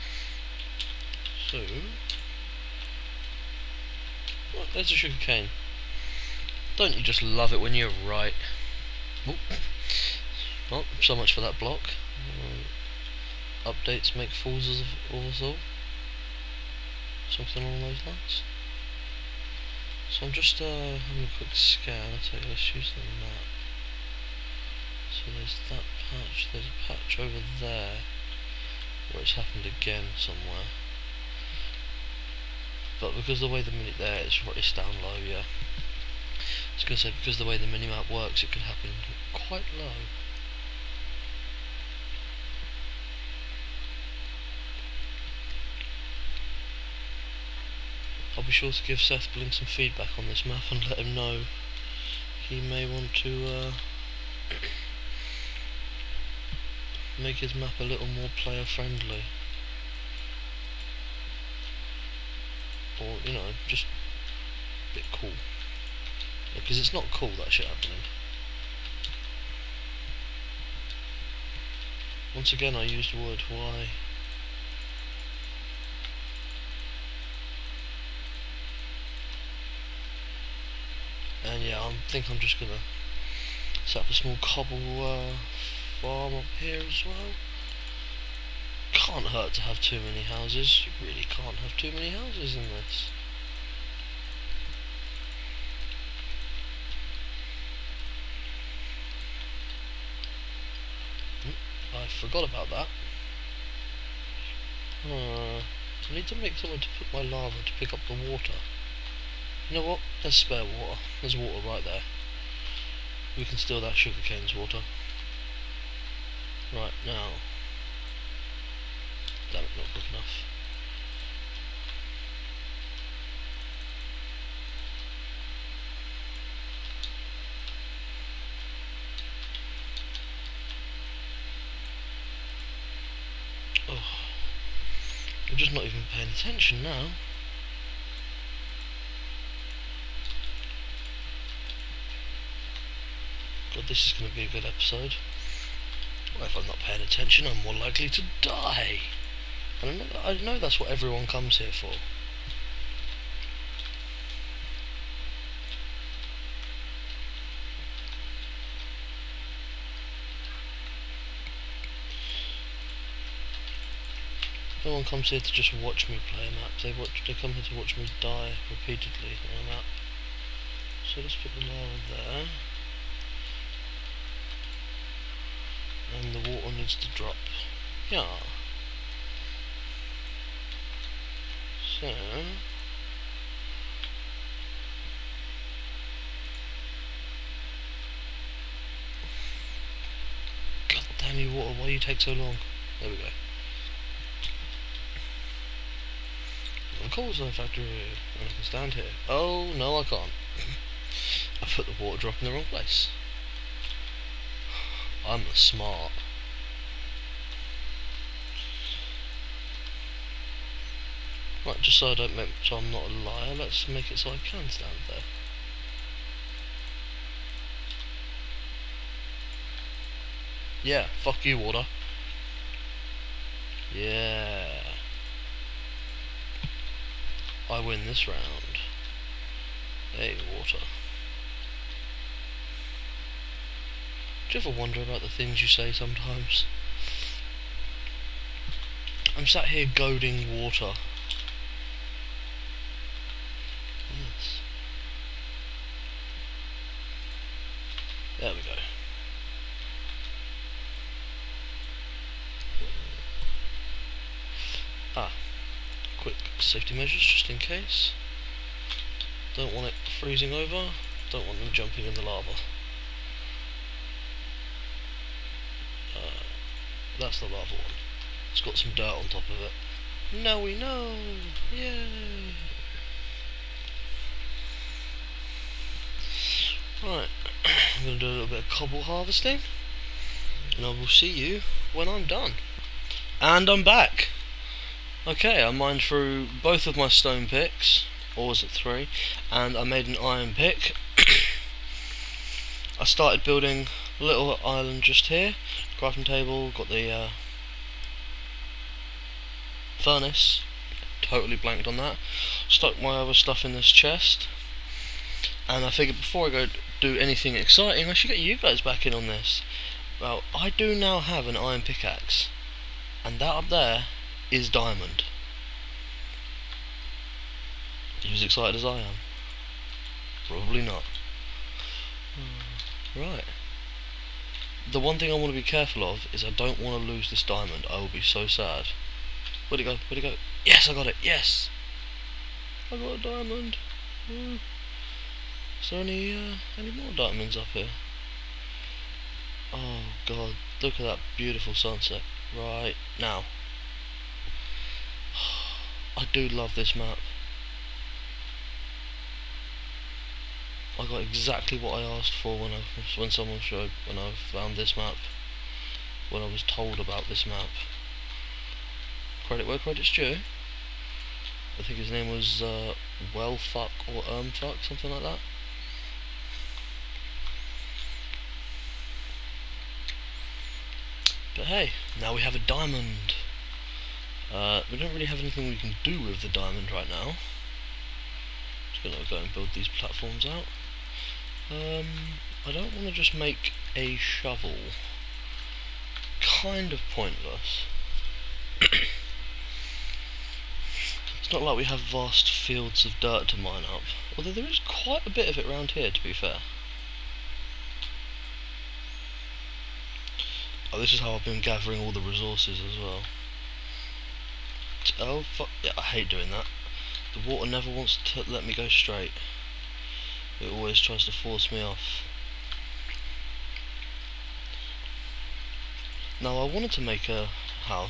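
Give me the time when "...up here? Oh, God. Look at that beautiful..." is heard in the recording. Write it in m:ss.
5:37.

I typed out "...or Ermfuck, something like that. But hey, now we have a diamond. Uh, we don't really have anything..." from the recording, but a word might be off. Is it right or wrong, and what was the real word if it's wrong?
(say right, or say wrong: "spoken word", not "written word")
right.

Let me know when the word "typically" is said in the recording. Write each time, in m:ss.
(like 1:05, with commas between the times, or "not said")
not said.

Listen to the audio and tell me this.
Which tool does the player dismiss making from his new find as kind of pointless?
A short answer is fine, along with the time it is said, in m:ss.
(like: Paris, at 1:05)
shovel, at 6:24.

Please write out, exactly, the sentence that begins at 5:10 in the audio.
Well, I do now have an iron pickaxe, and that up there is Diamond.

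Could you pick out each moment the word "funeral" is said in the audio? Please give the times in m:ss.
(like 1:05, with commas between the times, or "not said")
not said.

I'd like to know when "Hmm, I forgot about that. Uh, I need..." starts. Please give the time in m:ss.
1:41.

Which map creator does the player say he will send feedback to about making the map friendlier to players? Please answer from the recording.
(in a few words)
SethBling.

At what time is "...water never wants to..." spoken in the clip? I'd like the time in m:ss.
6:47.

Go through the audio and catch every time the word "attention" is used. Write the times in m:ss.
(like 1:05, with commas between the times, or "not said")
2:16, 2:27.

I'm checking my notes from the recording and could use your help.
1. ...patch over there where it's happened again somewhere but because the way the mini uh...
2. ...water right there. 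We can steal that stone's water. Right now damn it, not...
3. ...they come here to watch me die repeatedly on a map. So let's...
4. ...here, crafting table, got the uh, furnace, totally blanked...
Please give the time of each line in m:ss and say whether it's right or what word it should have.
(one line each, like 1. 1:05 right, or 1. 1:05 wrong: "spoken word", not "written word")
1. 0:26 right
2. 1:51 wrong: "sugarcane", not "stone"
3. 2:47 right
4. 4:55 right.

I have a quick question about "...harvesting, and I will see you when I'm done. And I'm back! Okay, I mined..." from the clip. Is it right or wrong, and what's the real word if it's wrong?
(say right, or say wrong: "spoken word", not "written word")
right.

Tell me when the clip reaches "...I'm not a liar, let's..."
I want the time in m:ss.
3:32.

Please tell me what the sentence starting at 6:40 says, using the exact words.
Oh, this is how I've been gathering all the resources as well.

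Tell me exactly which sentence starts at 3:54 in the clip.
Do you ever wonder about the things you say sometimes?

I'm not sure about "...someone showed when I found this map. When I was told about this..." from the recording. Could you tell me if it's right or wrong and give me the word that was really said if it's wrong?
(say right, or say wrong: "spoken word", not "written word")
right.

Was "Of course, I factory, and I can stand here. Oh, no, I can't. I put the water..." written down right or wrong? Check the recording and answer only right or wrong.
right.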